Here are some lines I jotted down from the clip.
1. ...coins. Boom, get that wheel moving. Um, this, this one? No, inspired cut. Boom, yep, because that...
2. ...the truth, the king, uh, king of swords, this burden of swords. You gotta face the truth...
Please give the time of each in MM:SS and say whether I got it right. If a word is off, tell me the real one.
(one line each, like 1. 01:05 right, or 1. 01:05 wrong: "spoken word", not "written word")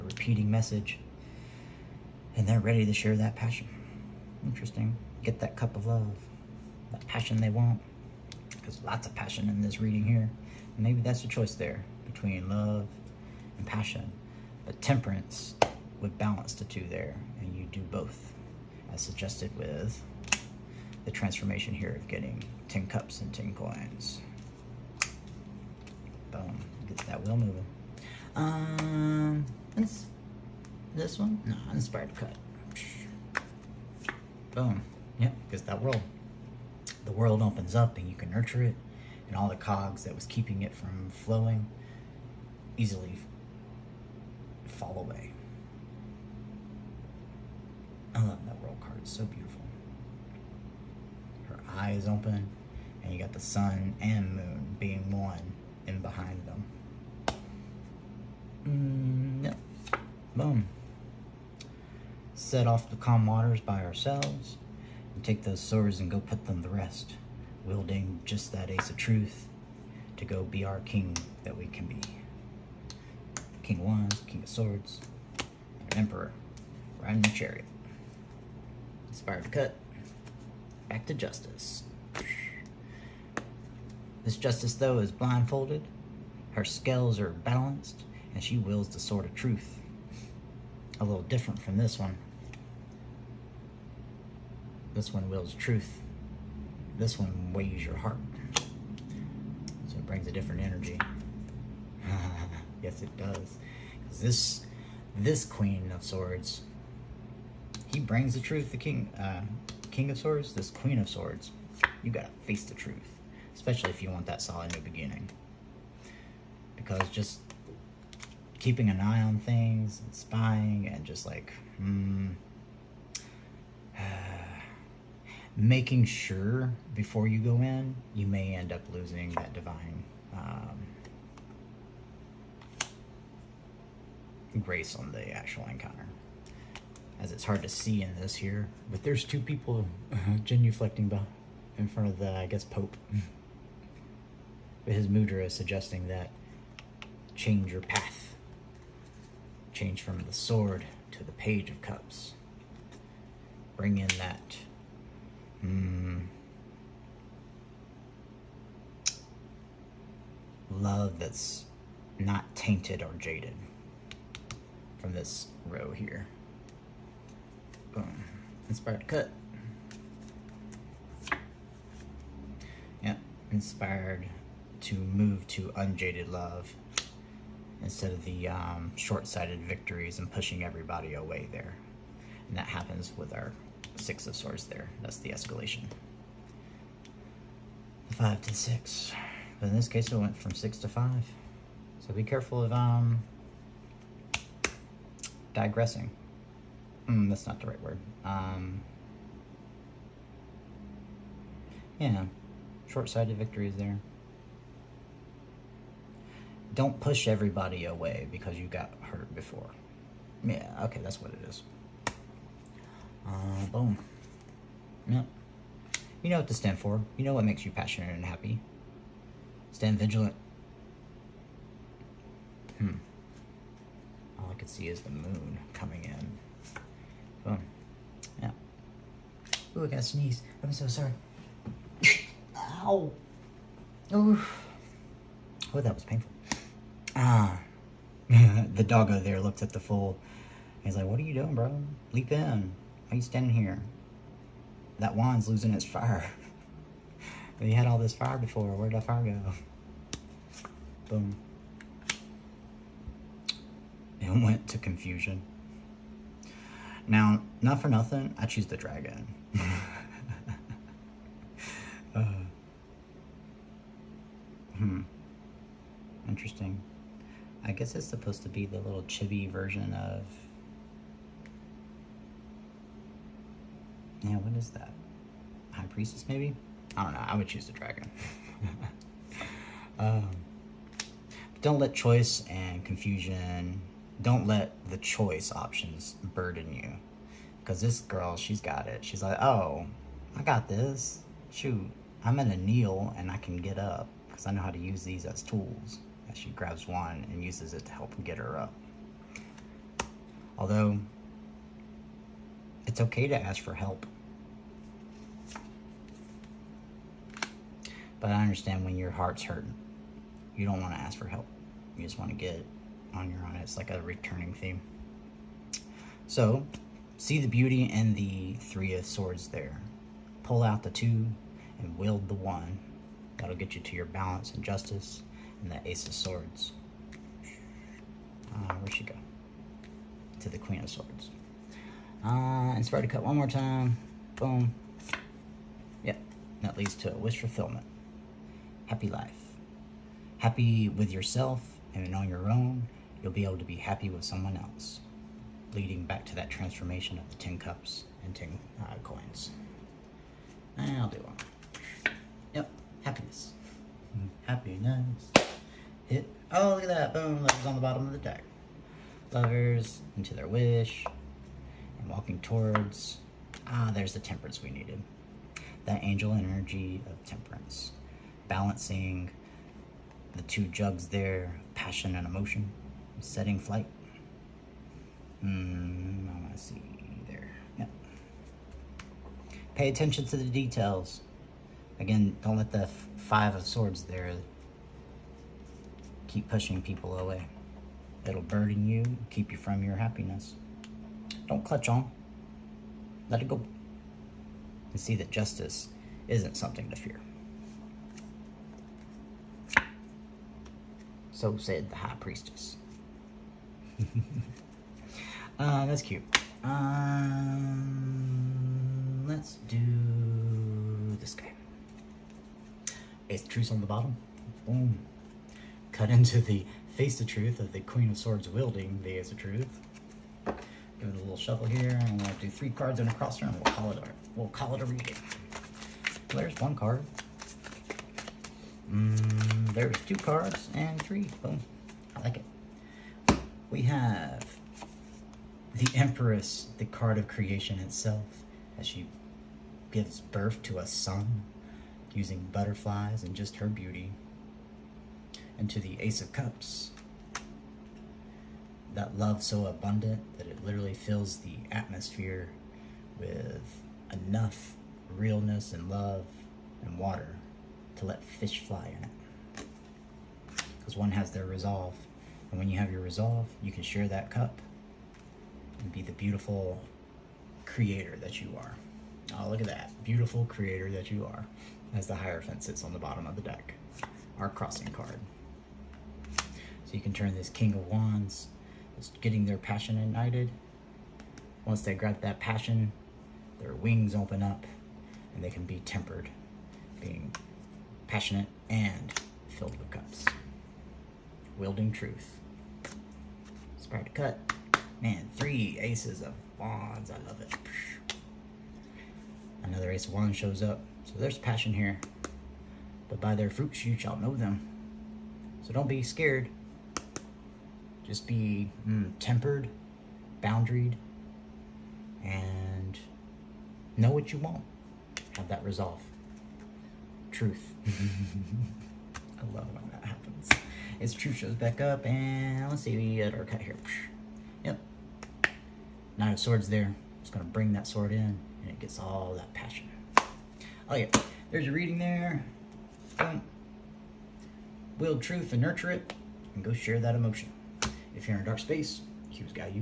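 1. 00:23 right
2. 01:48 wrong: "queen", not "burden".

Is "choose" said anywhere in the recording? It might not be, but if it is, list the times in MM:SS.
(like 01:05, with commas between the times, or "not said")
04:18, 04:37.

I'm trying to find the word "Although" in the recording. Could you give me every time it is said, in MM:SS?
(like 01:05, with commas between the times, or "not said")
05:00.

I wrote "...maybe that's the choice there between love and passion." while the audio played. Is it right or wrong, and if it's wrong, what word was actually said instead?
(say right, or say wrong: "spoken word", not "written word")
right.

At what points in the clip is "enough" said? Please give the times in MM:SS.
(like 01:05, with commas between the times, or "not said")
07:34.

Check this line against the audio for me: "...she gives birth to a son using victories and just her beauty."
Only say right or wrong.
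wrong.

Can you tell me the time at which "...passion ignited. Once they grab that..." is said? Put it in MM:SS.
07:59.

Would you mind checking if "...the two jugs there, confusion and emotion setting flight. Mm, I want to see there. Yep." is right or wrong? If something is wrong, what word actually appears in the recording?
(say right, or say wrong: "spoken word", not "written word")
wrong: "passion", not "confusion".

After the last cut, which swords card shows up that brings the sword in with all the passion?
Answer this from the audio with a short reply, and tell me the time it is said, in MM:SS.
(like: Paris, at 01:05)
Nine of Swords, at 08:46.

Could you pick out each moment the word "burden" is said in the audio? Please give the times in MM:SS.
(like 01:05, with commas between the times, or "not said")
04:46, 06:28.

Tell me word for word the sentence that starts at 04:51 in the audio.
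Shoot, I'm going to kneel and I can get up because I know how to use these as tools.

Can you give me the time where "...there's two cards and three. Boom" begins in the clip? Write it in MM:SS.
07:09.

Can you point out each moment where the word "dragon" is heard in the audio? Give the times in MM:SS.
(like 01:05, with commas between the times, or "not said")
04:18, 04:37.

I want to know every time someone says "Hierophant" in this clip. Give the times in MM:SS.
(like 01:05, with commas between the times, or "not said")
07:52.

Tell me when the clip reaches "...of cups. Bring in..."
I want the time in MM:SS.
02:31.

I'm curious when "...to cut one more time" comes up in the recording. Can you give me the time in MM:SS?
05:33.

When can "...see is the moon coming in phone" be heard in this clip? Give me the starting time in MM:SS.
03:44.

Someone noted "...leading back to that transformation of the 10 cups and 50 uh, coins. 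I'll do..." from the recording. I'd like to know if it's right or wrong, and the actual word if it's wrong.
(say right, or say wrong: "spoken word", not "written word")
wrong: "10", not "50".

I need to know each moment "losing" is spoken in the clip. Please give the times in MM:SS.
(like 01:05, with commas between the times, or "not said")
02:08, 04:05.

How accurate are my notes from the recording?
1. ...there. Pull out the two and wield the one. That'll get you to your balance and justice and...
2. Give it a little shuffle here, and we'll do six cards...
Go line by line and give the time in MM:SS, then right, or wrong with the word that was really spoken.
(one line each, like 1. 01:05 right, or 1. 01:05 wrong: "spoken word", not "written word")
1. 05:19 right
2. 07:00 wrong: "three", not "six".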